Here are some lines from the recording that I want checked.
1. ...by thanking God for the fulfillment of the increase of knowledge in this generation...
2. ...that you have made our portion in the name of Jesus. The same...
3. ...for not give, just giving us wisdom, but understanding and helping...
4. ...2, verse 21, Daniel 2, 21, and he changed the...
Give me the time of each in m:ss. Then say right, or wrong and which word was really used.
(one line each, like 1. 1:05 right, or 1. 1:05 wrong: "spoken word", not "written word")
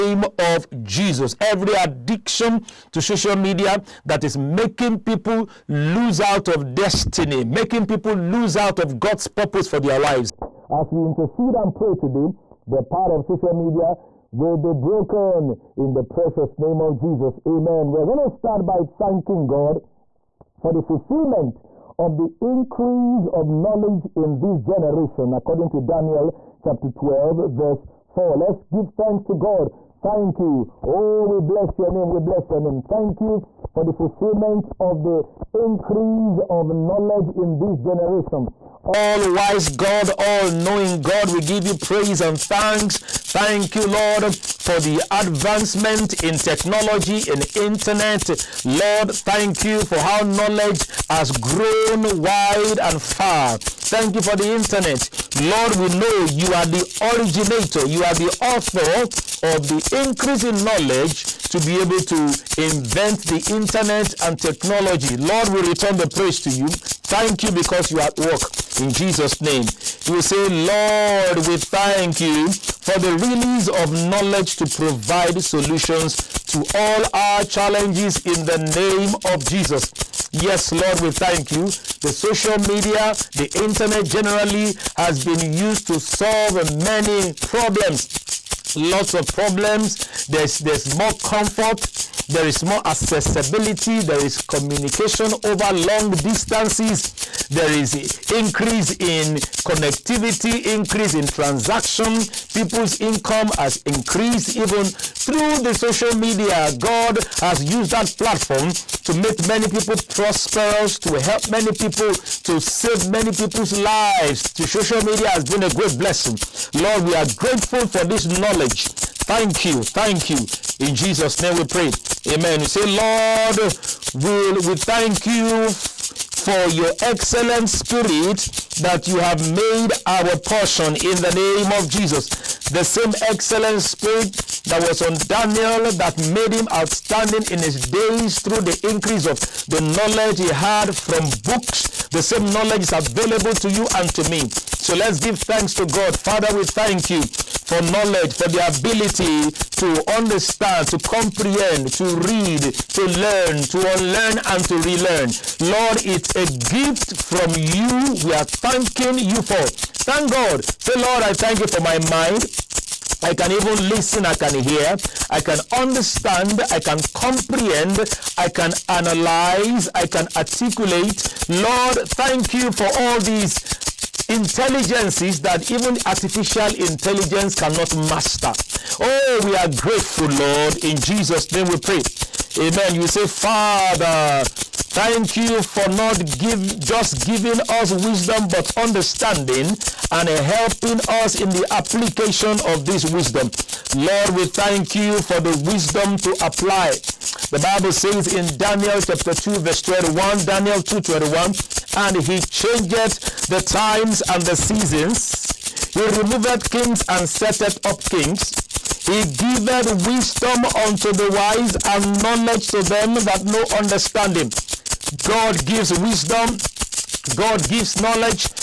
1. 0:18 right
2. 2:08 right
3. 3:05 right
4. 3:19 right.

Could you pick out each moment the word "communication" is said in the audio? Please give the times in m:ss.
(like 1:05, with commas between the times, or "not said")
1:34.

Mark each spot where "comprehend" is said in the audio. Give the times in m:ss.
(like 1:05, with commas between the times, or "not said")
2:30, 2:47.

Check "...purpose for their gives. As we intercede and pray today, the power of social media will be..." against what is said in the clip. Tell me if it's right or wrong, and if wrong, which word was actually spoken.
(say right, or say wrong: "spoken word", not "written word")
wrong: "lives", not "gives".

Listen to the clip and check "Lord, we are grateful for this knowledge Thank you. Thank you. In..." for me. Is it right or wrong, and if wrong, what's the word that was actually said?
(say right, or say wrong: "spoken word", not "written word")
right.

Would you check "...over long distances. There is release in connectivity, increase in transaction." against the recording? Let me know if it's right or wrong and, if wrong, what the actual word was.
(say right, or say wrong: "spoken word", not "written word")
wrong: "increase", not "release".